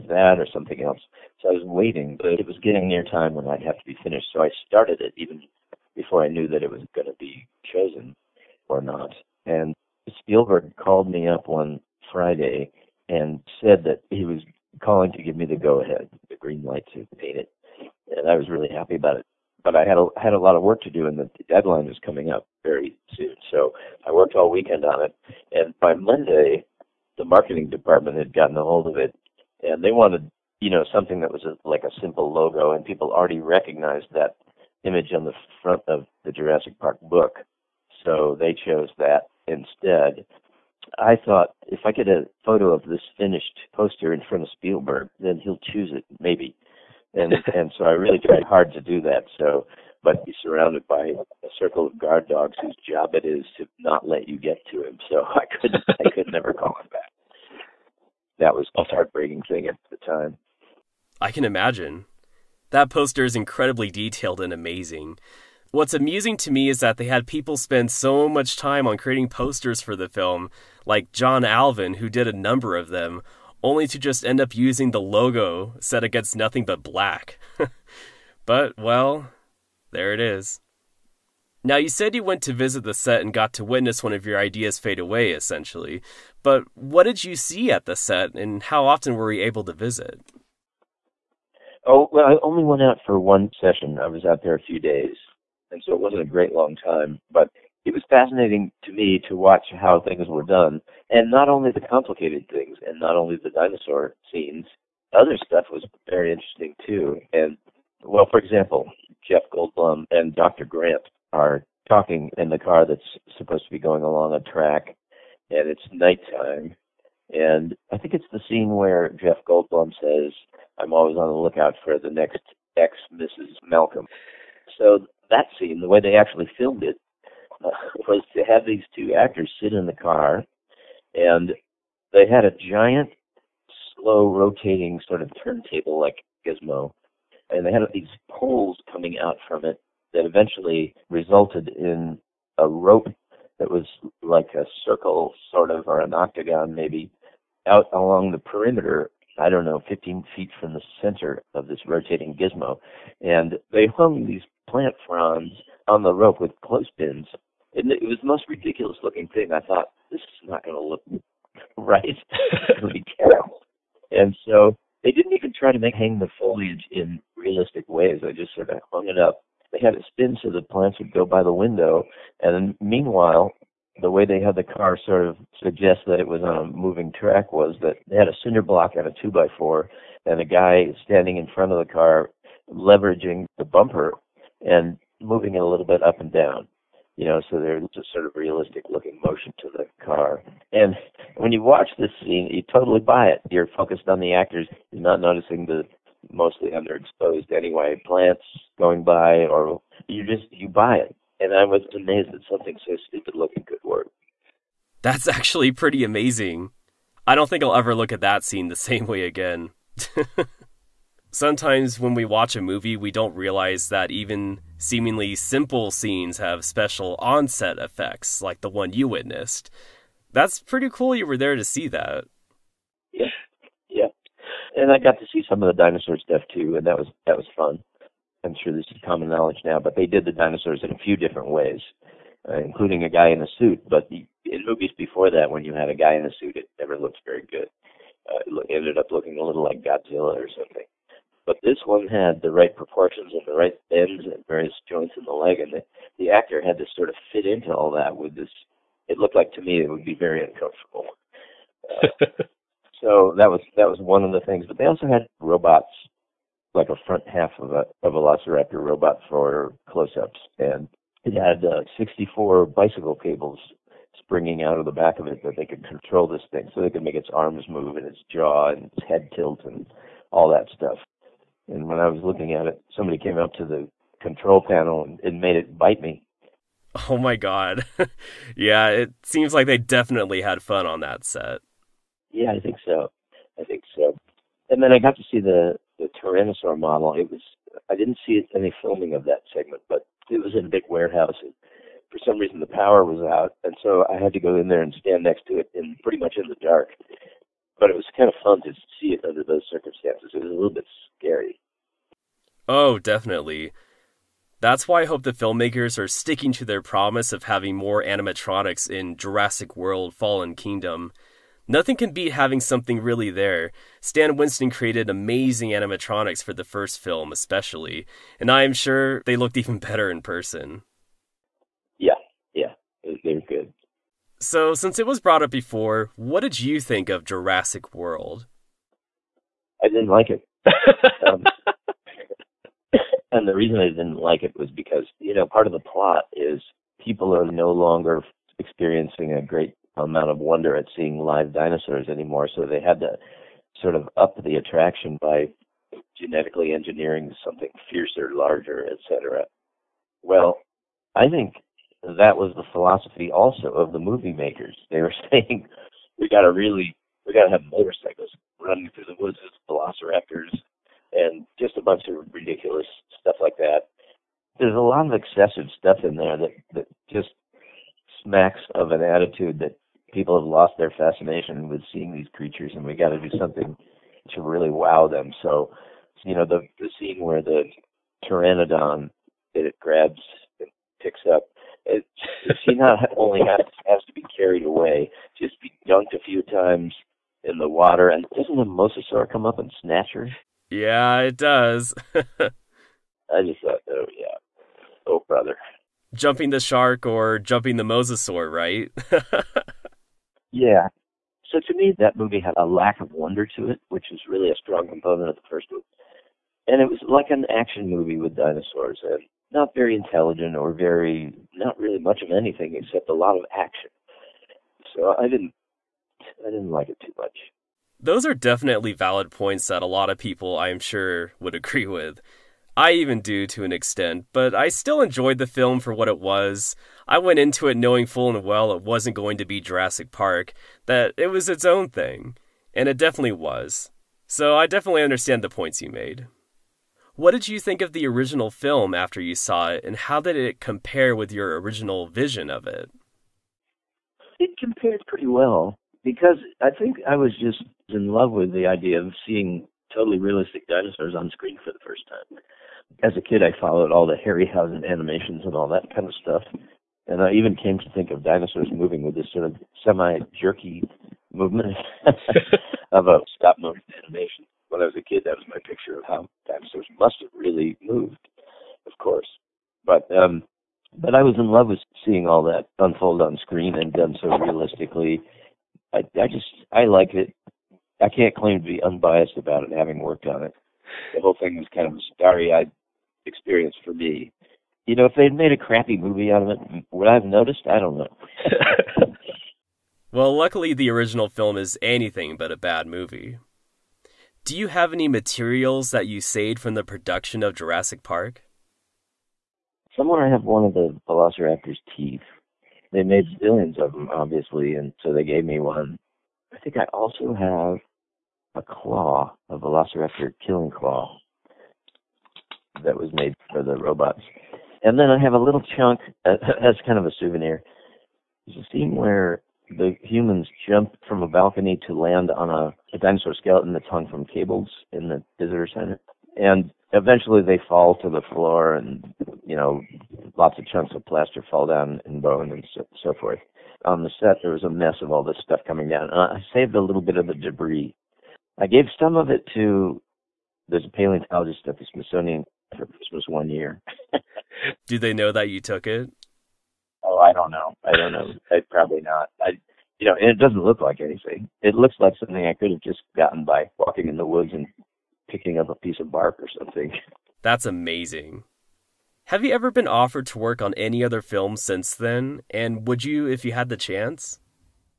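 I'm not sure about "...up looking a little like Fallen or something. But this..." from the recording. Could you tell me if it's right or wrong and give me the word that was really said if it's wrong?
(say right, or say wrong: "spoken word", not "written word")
wrong: "Godzilla", not "Fallen".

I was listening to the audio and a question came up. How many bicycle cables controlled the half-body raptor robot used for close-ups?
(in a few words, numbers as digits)
64.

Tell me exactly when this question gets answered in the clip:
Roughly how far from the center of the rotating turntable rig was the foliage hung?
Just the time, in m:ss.
2:29.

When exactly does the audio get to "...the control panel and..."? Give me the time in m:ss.
4:33.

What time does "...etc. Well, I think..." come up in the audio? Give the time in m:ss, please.
5:48.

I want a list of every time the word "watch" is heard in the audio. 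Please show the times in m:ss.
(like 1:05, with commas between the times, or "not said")
1:39, 3:11, 3:32.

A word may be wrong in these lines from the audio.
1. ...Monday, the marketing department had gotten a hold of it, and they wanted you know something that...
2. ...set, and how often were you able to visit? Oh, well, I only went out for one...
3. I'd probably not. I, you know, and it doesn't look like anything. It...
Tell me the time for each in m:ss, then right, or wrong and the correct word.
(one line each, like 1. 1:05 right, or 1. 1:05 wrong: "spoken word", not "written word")
1. 0:25 right
2. 1:27 right
3. 9:08 right.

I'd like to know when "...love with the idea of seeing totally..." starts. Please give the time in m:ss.
7:28.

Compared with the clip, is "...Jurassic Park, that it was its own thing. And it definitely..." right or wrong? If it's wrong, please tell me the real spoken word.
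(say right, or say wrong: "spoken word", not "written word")
right.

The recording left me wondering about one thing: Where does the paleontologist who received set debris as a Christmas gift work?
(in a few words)
Smithsonian.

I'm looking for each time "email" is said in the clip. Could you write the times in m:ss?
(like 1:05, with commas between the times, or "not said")
not said.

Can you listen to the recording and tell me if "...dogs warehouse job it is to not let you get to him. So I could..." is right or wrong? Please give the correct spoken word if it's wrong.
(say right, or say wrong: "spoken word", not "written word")
wrong: "whose", not "warehouse".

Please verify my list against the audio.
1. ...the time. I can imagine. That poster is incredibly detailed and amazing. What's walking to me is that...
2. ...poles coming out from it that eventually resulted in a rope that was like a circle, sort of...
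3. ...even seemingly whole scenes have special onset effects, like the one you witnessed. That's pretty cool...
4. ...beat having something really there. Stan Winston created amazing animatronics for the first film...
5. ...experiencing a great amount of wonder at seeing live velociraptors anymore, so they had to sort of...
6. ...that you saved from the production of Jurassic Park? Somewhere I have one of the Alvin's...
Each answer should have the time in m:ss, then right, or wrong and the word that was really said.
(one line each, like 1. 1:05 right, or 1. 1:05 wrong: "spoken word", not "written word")
1. 0:59 wrong: "amusing", not "walking"
2. 2:18 right
3. 3:34 wrong: "simple", not "whole"
4. 5:12 right
5. 5:38 wrong: "dinosaurs", not "velociraptors"
6. 8:15 wrong: "Velociraptor", not "Alvin".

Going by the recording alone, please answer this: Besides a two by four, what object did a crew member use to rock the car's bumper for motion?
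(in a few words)
cinder block.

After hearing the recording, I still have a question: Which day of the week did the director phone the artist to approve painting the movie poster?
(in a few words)
Friday.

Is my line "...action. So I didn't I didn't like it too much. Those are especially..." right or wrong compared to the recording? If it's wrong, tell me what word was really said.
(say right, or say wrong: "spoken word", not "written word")
wrong: "definitely", not "especially".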